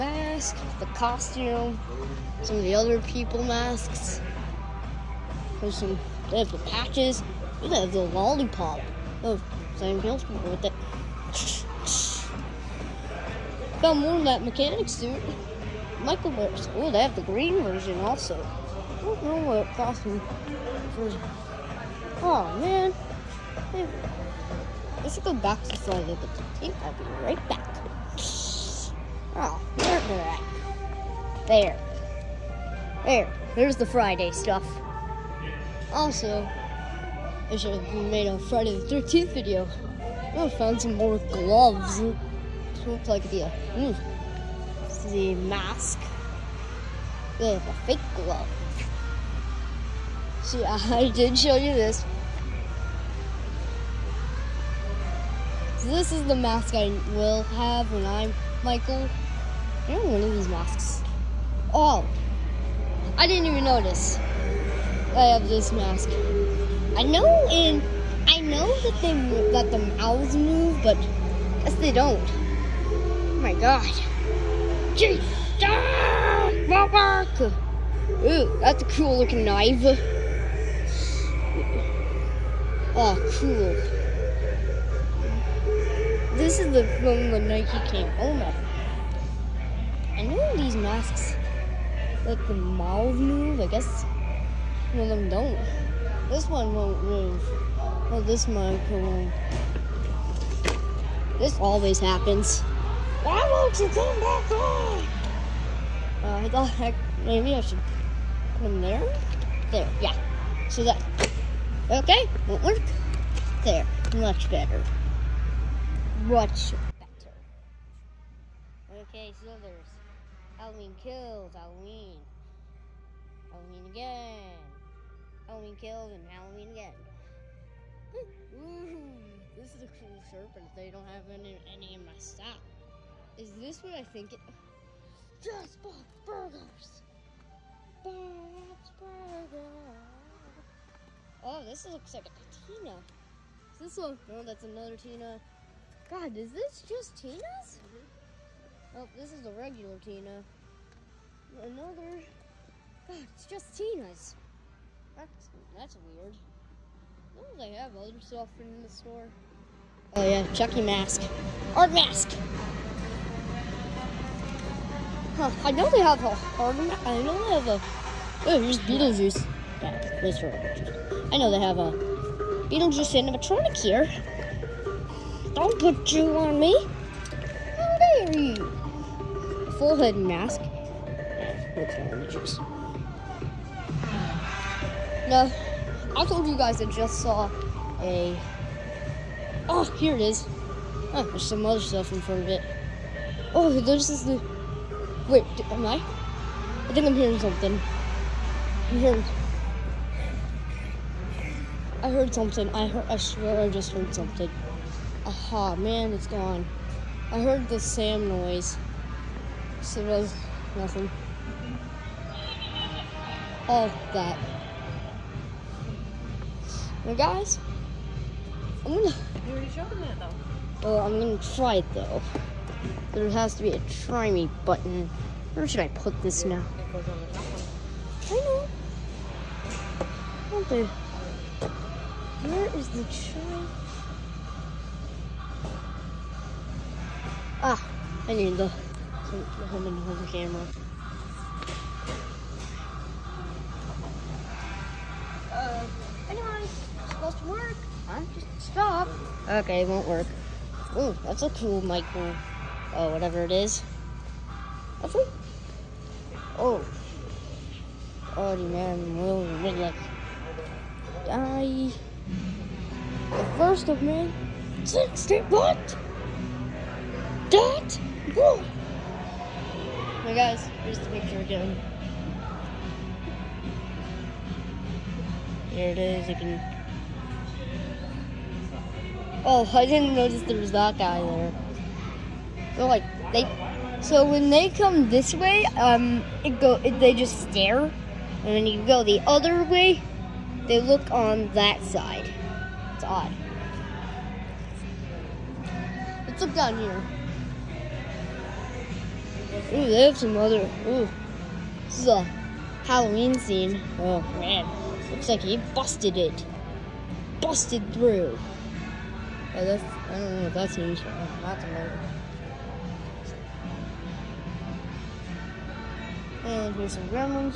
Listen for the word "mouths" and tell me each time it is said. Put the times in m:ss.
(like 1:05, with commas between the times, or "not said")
1:09, 1:32.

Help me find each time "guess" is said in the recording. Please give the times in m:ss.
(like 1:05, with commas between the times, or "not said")
1:11, 1:33.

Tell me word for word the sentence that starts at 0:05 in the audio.
There's some, they have the patches.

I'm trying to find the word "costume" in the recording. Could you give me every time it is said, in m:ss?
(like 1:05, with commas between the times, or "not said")
0:00, 0:19.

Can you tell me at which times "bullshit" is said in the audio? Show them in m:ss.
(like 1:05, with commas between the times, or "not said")
not said.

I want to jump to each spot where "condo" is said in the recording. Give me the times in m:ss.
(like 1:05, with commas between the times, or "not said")
not said.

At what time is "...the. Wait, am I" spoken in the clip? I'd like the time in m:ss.
3:14.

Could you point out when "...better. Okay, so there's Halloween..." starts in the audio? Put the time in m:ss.
1:56.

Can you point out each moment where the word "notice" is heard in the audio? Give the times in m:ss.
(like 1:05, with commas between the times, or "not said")
1:03, 4:40.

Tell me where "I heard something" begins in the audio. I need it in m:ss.
3:22.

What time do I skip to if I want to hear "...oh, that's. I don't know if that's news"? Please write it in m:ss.
5:09.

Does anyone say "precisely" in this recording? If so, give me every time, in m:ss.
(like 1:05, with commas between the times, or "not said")
not said.